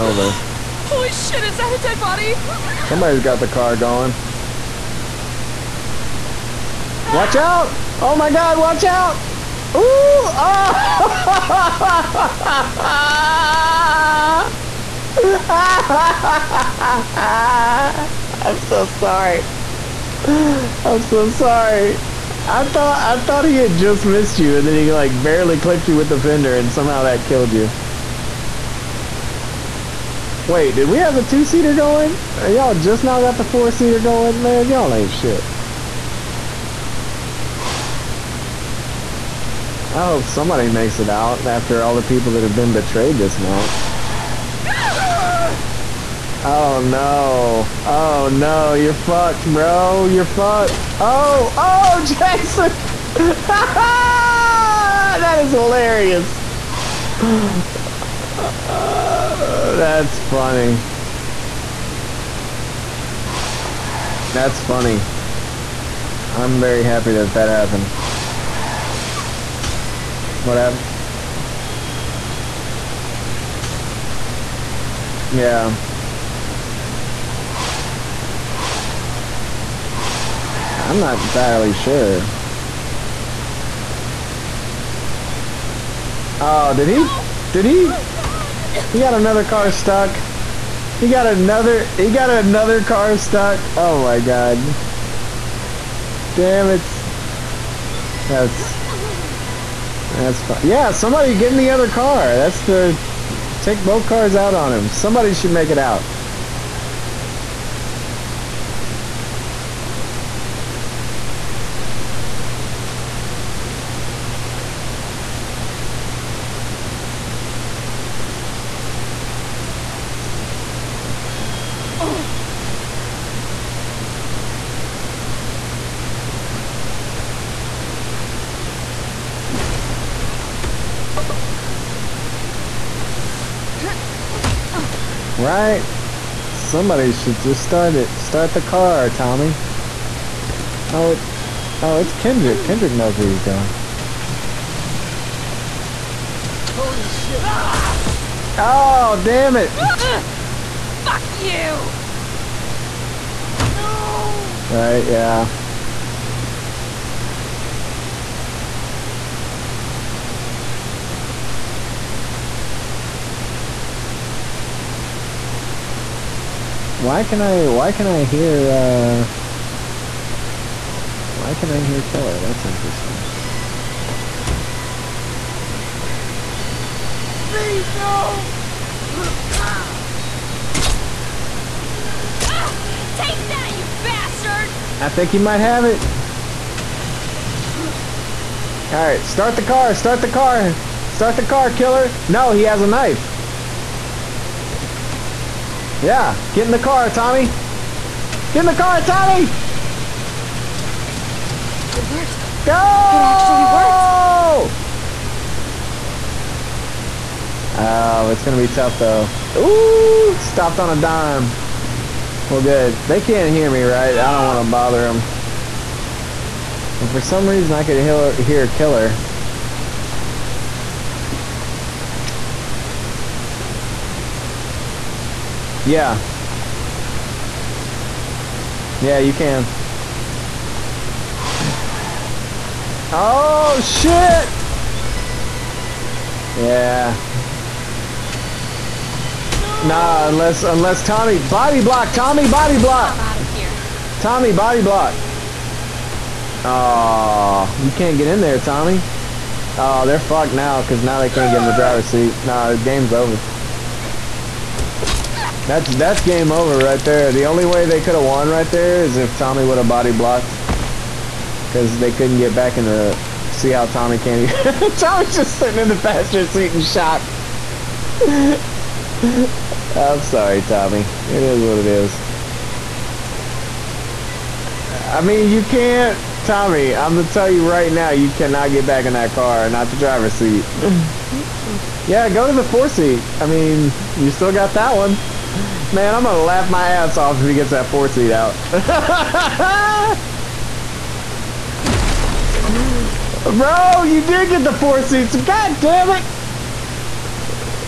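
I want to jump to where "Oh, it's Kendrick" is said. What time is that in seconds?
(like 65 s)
141 s.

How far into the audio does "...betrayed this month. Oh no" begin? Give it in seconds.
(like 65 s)
42 s.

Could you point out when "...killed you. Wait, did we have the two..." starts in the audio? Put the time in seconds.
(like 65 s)
27 s.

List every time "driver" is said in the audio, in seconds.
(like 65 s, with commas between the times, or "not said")
251 s, 279 s.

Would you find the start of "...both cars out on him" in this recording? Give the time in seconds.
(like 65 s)
103 s.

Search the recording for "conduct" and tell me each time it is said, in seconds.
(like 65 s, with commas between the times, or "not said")
not said.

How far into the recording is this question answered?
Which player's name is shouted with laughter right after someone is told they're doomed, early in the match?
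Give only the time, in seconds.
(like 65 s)
52 s.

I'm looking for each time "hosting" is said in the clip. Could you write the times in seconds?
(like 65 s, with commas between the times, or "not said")
not said.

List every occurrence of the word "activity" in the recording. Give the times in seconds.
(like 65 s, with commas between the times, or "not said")
not said.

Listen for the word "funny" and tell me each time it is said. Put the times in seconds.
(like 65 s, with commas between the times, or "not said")
60 s, 64 s.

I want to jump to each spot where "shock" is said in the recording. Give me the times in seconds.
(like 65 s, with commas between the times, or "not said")
266 s.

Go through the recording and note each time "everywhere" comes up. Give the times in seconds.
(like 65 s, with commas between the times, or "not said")
not said.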